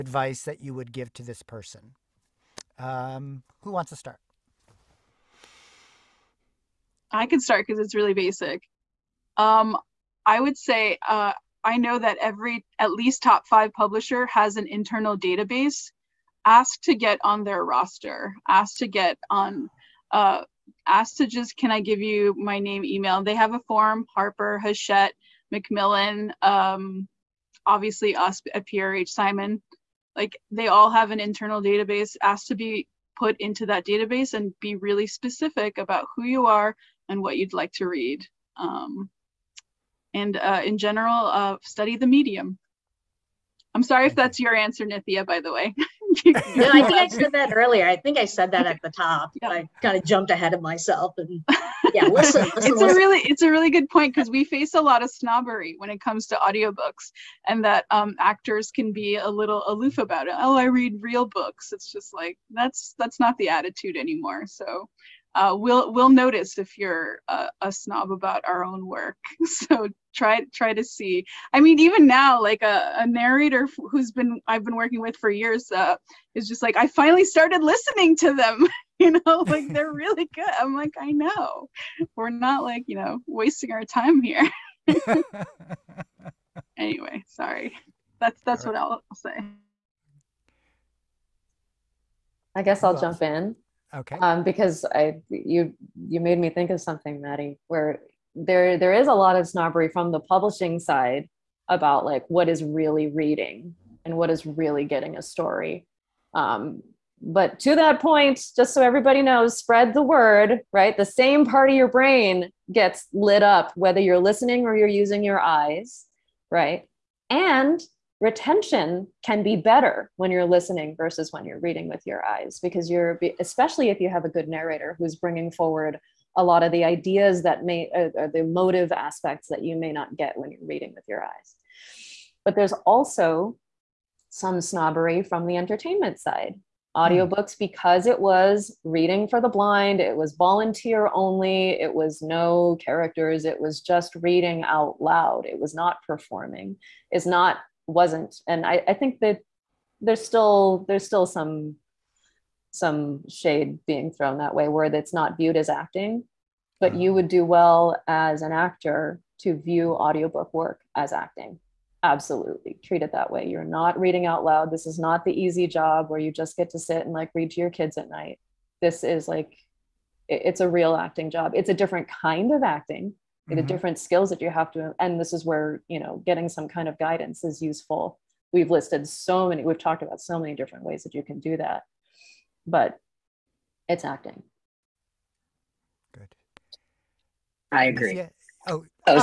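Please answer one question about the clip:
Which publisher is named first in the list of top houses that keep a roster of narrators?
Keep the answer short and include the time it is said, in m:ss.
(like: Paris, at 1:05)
Harper, at 0:24.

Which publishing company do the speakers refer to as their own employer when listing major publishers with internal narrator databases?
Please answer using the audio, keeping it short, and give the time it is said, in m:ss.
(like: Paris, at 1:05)
PRH, at 0:28.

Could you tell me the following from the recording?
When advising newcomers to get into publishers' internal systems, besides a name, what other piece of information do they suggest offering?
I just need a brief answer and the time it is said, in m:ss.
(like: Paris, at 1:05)
Email, at 0:22.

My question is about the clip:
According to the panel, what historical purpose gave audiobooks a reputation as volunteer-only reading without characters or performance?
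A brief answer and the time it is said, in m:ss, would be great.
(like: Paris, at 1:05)
Reading for the blind, at 2:18.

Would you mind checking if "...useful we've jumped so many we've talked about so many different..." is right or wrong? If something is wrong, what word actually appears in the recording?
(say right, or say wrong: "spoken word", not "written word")
wrong: "listed", not "jumped".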